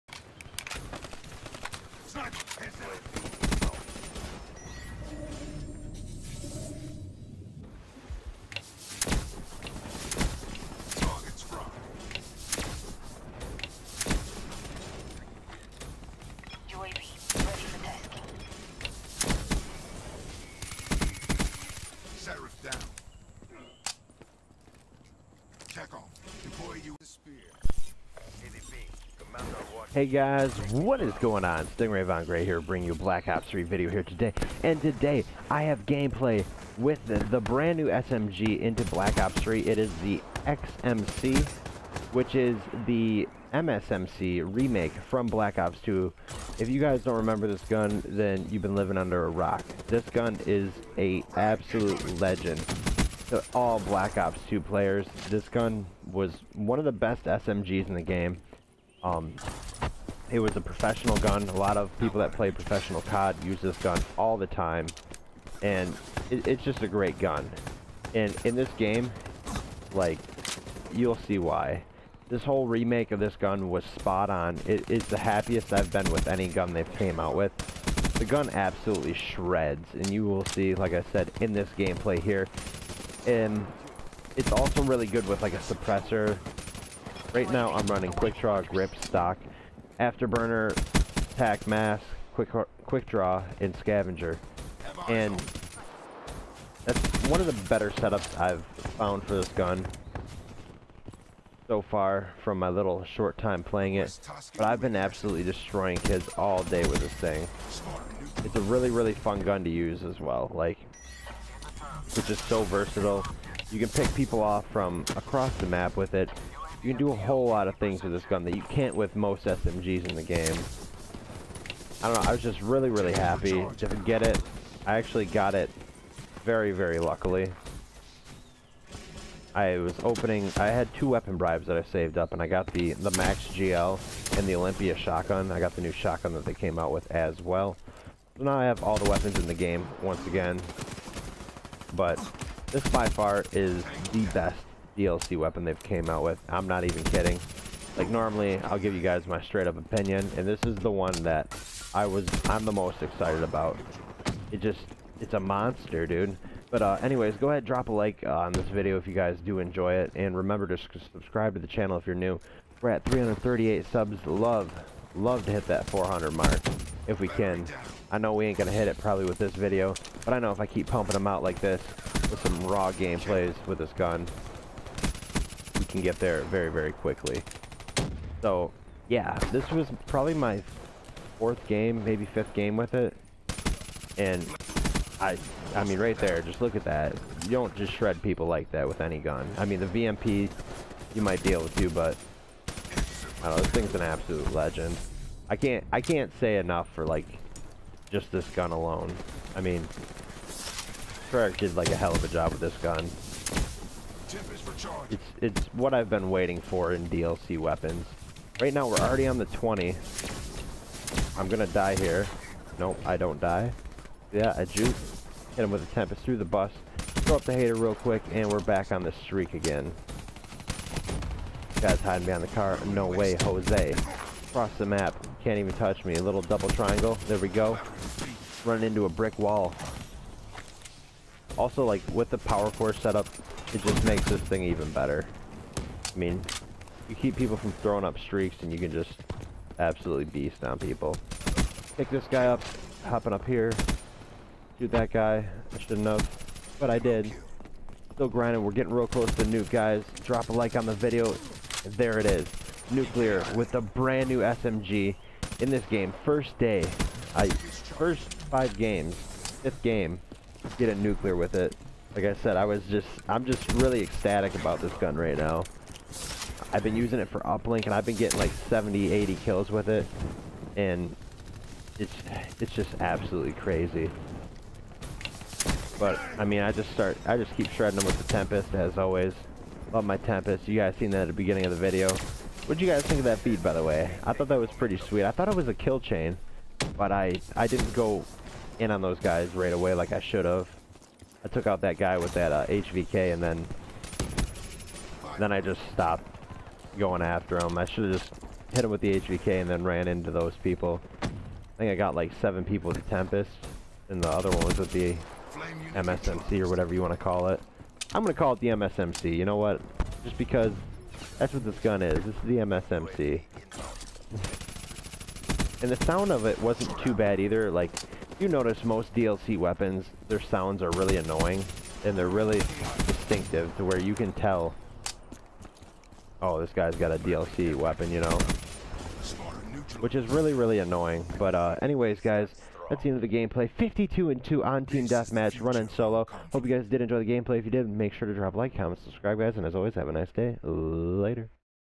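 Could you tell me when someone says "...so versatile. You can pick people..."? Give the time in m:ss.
1:52.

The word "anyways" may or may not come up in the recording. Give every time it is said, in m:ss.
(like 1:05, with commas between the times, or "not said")
2:37, 5:31.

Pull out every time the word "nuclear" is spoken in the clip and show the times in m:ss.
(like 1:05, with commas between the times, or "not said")
4:12, 4:20.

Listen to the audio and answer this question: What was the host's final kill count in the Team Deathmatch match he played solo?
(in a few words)
52.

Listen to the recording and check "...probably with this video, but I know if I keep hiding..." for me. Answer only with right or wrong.
wrong.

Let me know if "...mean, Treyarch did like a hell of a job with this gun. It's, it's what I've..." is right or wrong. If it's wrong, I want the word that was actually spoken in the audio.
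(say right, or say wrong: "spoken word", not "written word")
right.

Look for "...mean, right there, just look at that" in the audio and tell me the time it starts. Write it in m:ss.
3:05.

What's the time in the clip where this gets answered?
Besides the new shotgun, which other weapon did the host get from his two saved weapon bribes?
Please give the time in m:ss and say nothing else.
2:13.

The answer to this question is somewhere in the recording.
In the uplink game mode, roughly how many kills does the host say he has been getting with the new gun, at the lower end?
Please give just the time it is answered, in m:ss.
4:28.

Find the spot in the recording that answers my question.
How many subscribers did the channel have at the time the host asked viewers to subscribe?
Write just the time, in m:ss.
2:43.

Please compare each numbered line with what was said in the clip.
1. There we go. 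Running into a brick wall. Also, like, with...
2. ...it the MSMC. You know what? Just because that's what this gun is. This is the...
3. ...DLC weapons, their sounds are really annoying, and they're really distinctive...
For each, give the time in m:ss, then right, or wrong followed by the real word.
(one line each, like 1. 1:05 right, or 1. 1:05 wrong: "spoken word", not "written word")
1. 3:47 right
2. 5:08 right
3. 5:19 right.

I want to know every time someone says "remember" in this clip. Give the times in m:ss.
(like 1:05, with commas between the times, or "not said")
0:47, 2:40.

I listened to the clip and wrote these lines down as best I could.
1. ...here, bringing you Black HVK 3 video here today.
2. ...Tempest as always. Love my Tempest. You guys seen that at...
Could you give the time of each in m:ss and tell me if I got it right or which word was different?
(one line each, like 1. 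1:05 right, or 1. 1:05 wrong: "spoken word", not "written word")
1. 0:32 wrong: "Ops", not "HVK"
2. 4:38 right.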